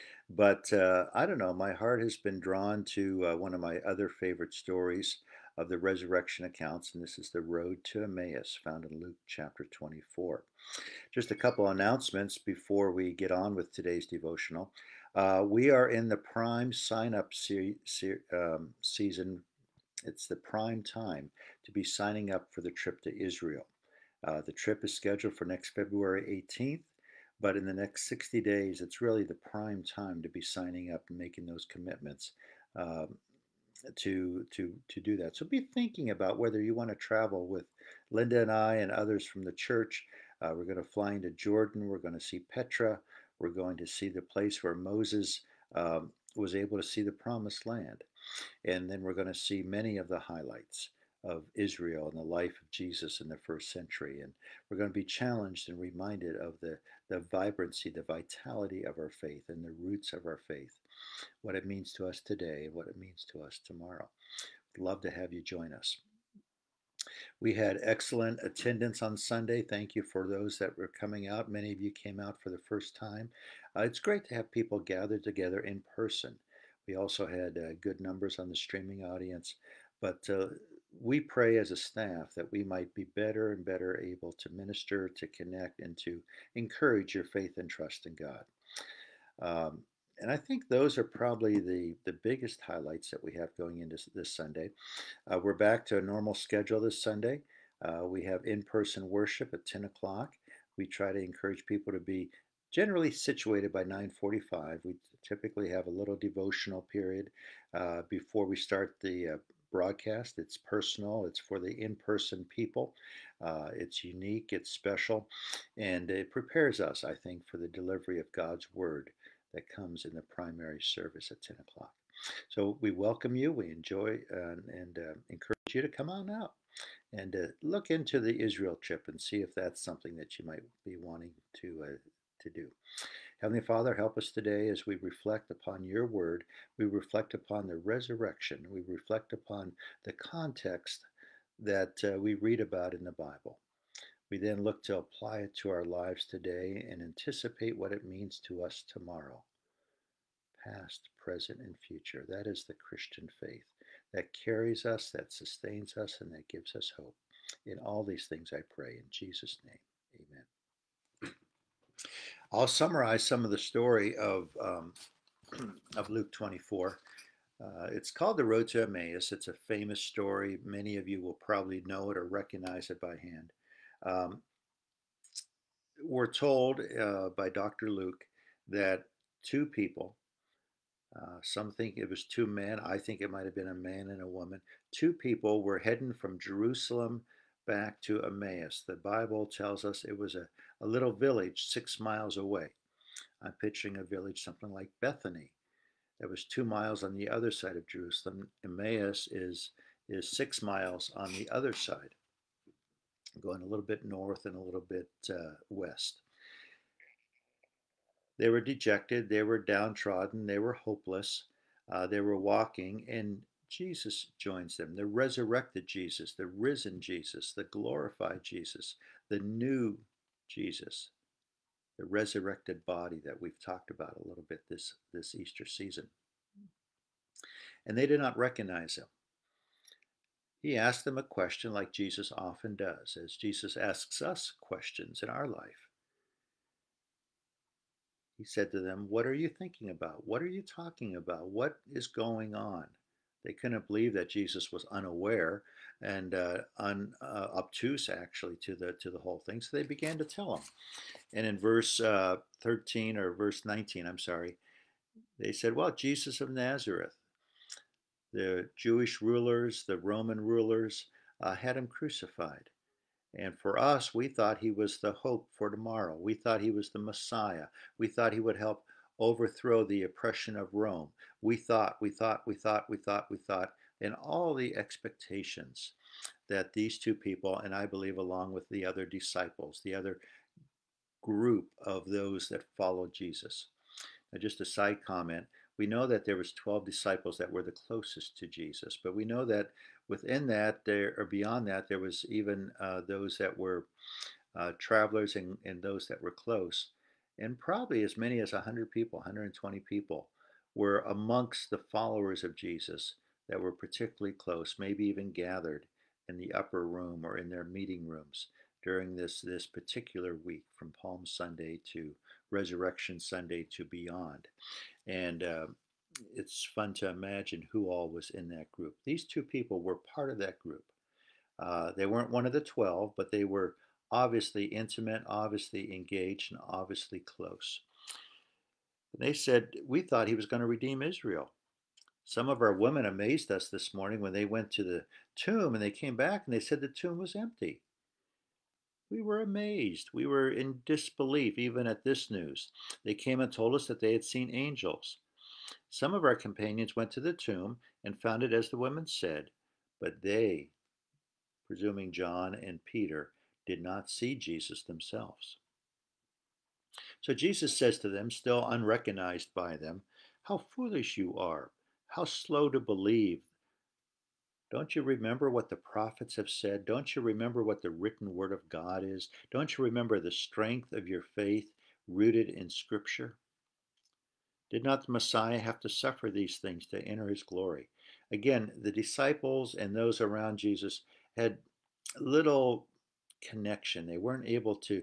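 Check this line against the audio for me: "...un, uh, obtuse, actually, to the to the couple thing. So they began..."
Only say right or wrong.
wrong.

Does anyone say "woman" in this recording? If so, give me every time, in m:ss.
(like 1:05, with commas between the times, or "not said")
3:04.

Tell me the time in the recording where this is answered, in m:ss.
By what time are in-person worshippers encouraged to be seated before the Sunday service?
1:43.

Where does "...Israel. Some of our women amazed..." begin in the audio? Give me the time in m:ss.
5:31.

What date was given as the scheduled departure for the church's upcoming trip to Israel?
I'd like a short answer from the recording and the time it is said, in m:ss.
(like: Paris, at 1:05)
February 18th, at 0:25.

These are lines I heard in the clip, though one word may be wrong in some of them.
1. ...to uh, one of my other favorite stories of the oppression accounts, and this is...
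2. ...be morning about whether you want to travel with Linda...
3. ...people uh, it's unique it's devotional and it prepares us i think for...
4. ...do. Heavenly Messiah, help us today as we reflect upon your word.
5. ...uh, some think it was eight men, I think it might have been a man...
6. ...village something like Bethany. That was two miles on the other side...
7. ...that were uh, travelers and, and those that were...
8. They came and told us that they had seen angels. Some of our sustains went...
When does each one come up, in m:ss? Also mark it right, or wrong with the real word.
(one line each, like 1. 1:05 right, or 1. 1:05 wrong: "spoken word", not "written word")
1. 0:02 wrong: "resurrection", not "oppression"
2. 0:35 wrong: "thinking", not "morning"
3. 1:52 wrong: "special", not "devotional"
4. 2:12 wrong: "Father", not "Messiah"
5. 3:01 wrong: "two", not "eight"
6. 3:14 right
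7. 4:53 right
8. 5:43 wrong: "companions", not "sustains".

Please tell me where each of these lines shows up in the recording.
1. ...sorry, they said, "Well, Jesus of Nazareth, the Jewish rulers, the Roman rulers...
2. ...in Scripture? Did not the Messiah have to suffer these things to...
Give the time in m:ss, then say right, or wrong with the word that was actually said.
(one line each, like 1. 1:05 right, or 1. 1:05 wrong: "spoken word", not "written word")
1. 4:14 right
2. 6:12 right.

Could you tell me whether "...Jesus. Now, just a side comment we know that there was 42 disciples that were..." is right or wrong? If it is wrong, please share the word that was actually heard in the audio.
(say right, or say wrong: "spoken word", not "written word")
wrong: "12", not "42".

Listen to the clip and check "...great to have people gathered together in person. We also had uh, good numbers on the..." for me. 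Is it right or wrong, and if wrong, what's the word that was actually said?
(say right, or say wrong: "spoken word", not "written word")
right.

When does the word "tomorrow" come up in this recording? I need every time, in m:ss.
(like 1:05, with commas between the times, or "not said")
1:03, 2:28, 4:25.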